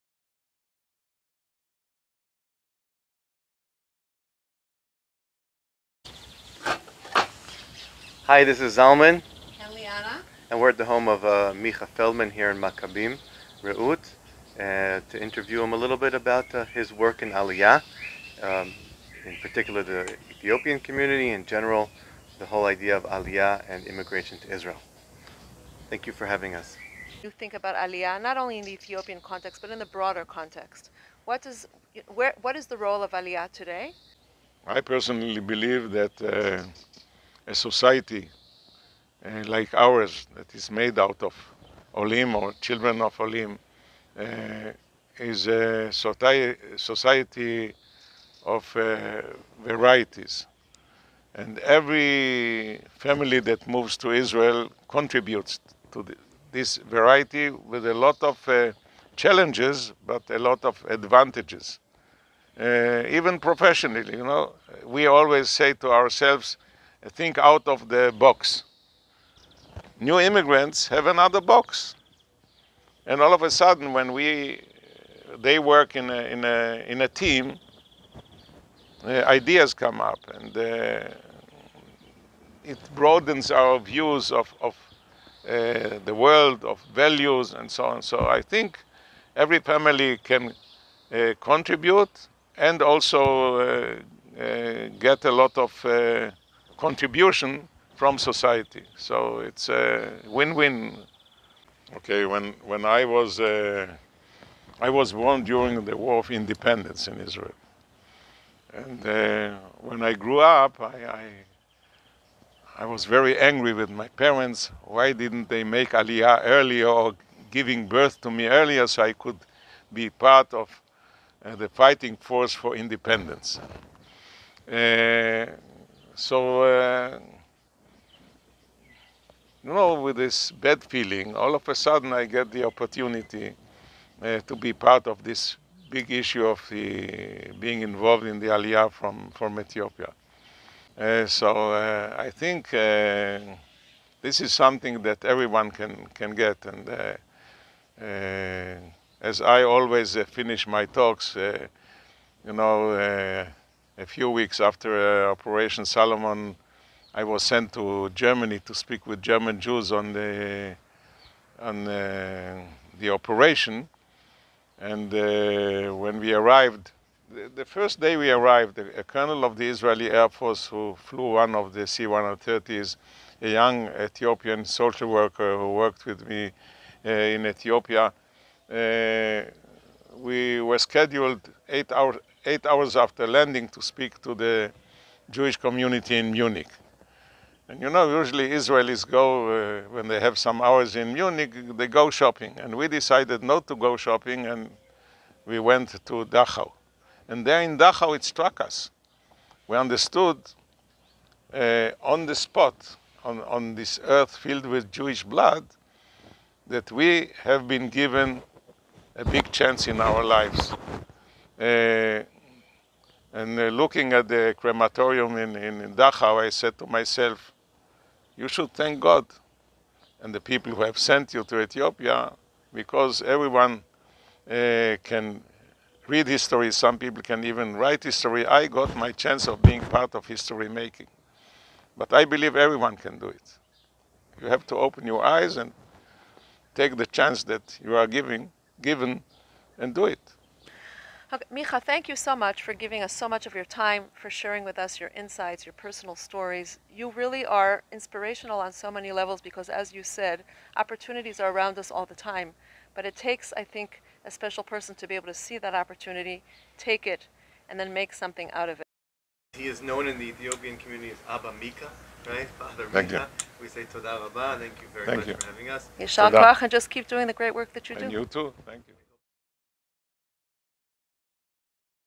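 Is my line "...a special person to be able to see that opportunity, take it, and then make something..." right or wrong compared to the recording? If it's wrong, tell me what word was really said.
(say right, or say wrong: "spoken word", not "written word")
right.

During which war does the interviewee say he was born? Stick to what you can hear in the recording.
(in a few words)
War of Independence.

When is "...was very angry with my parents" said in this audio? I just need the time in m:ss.
1:52.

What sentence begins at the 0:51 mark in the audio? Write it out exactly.
And every family that moves to Israel contributes to the, this variety with a lot of challenges, but a lot of advantages.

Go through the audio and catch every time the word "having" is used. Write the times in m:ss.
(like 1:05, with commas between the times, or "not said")
0:26, 4:25.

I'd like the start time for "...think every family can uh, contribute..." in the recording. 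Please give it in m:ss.
1:28.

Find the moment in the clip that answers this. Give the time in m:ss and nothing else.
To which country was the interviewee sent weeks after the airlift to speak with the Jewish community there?
2:38.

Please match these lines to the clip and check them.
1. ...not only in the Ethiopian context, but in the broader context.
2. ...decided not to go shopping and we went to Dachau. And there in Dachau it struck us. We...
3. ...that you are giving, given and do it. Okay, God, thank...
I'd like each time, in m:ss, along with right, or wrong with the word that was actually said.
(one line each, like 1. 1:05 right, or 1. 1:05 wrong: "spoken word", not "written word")
1. 0:28 right
2. 3:12 right
3. 3:57 wrong: "Micha", not "God".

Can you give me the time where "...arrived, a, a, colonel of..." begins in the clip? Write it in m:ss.
2:48.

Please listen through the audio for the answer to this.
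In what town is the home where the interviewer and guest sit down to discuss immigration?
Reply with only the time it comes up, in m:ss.
0:12.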